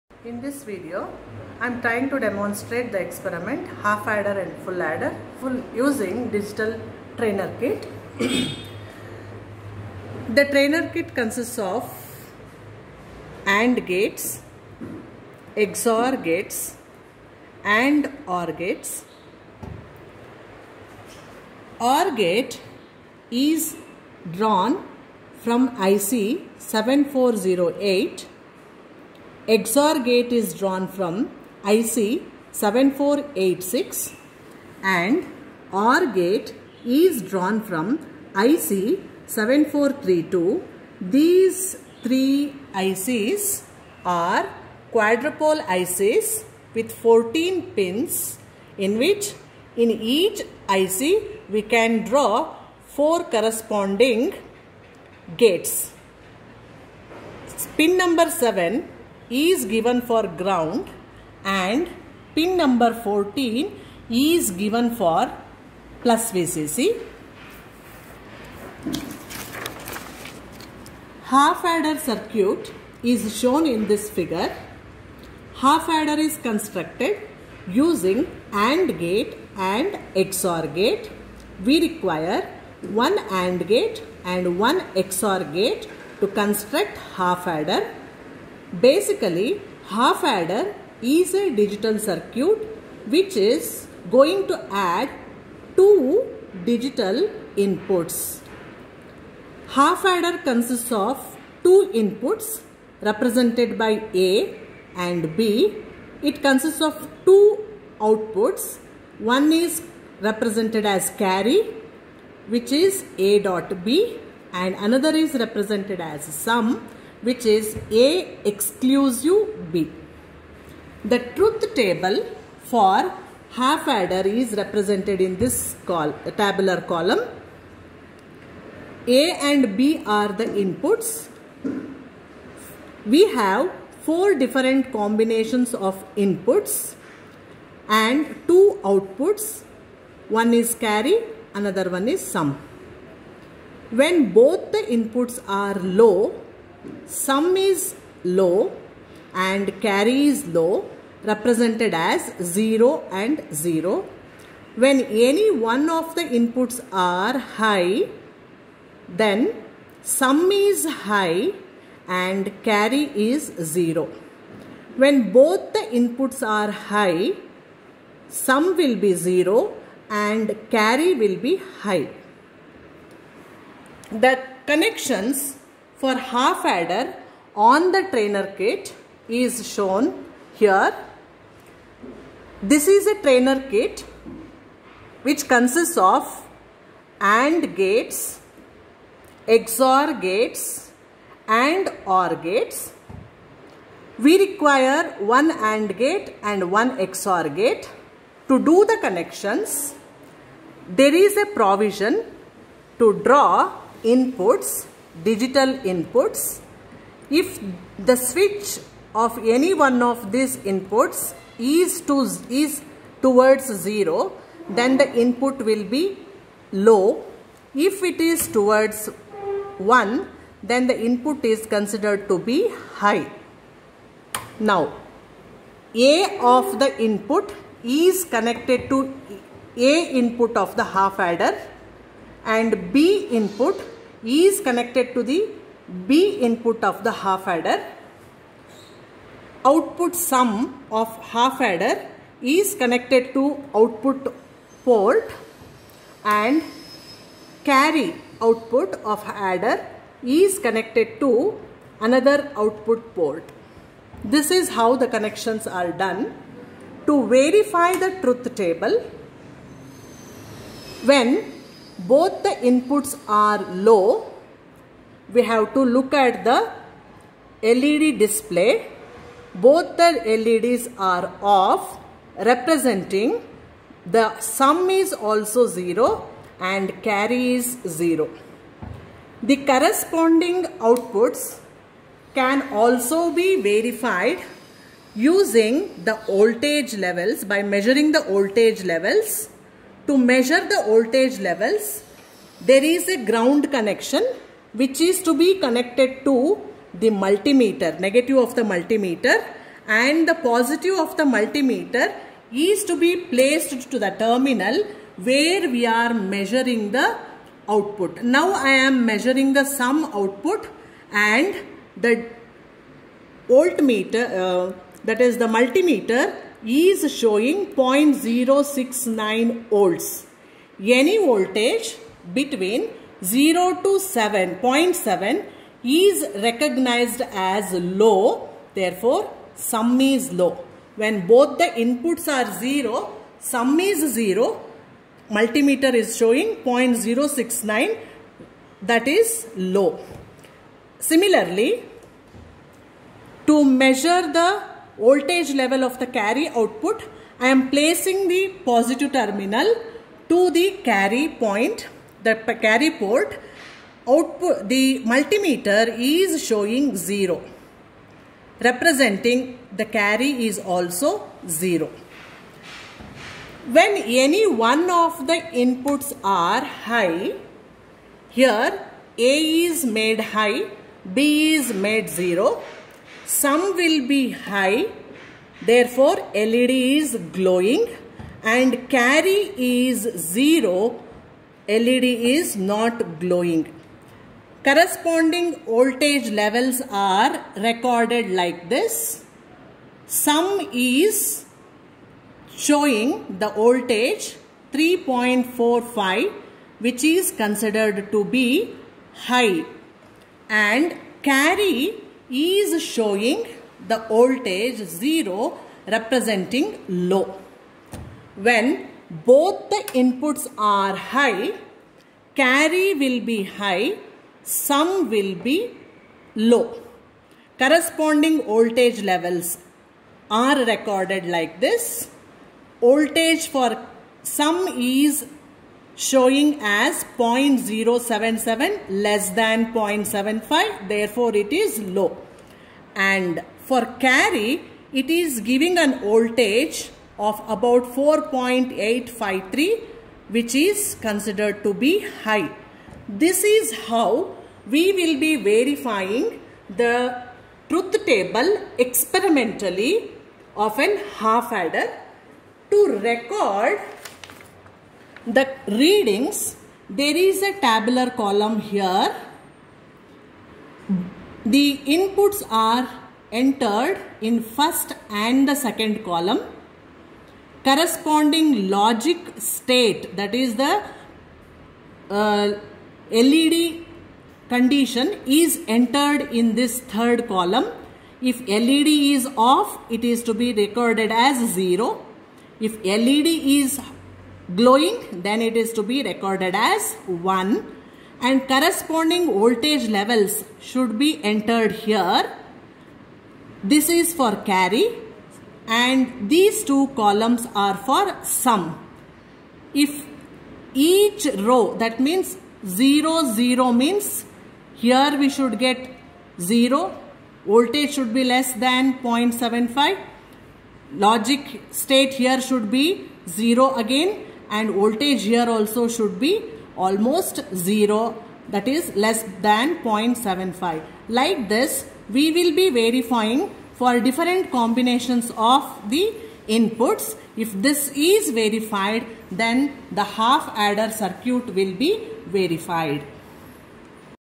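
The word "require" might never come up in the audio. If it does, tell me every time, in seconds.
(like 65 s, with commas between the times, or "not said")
81 s, 194 s.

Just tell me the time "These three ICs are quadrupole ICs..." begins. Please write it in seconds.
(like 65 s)
41 s.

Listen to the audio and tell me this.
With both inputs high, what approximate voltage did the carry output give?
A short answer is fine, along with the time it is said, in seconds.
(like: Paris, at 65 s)
4.853, at 437 s.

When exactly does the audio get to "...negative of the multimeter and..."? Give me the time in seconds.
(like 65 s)
298 s.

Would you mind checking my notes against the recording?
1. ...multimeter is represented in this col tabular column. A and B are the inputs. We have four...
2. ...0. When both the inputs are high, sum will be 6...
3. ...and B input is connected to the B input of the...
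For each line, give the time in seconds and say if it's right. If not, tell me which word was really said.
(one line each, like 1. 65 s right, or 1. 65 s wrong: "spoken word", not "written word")
1. 123 s wrong: "adder", not "multimeter"
2. 163 s wrong: "0", not "6"
3. 232 s right.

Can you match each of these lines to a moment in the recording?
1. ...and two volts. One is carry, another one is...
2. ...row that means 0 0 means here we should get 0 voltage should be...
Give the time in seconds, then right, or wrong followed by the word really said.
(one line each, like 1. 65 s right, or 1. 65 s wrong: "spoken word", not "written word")
1. 137 s wrong: "outputs", not "volts"
2. 501 s right.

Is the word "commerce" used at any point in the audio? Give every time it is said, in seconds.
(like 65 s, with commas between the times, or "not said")
not said.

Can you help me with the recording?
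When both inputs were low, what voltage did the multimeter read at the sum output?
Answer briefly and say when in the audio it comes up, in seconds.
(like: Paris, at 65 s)
0.069 volts, at 317 s.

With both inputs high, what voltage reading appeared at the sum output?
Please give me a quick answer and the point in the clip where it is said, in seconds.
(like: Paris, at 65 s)
0.077, at 427 s.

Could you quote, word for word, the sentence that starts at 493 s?
This is for carry and these two columns are for sum.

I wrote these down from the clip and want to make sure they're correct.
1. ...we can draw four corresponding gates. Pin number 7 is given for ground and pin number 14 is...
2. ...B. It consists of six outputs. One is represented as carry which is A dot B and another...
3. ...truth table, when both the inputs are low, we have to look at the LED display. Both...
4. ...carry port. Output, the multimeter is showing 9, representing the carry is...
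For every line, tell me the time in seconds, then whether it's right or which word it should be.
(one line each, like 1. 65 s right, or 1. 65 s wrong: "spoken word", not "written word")
1. 51 s right
2. 105 s wrong: "two", not "six"
3. 258 s right
4. 352 s wrong: "0", not "9".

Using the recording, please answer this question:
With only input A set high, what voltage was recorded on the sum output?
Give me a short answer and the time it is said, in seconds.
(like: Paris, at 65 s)
3.45, at 394 s.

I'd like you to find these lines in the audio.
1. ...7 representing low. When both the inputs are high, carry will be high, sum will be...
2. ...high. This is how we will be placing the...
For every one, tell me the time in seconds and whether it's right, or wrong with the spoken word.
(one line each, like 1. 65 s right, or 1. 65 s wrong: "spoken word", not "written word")
1. 404 s wrong: "0", not "7"
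2. 442 s wrong: "verifying", not "placing".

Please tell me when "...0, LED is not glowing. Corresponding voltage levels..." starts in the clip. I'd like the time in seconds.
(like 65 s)
380 s.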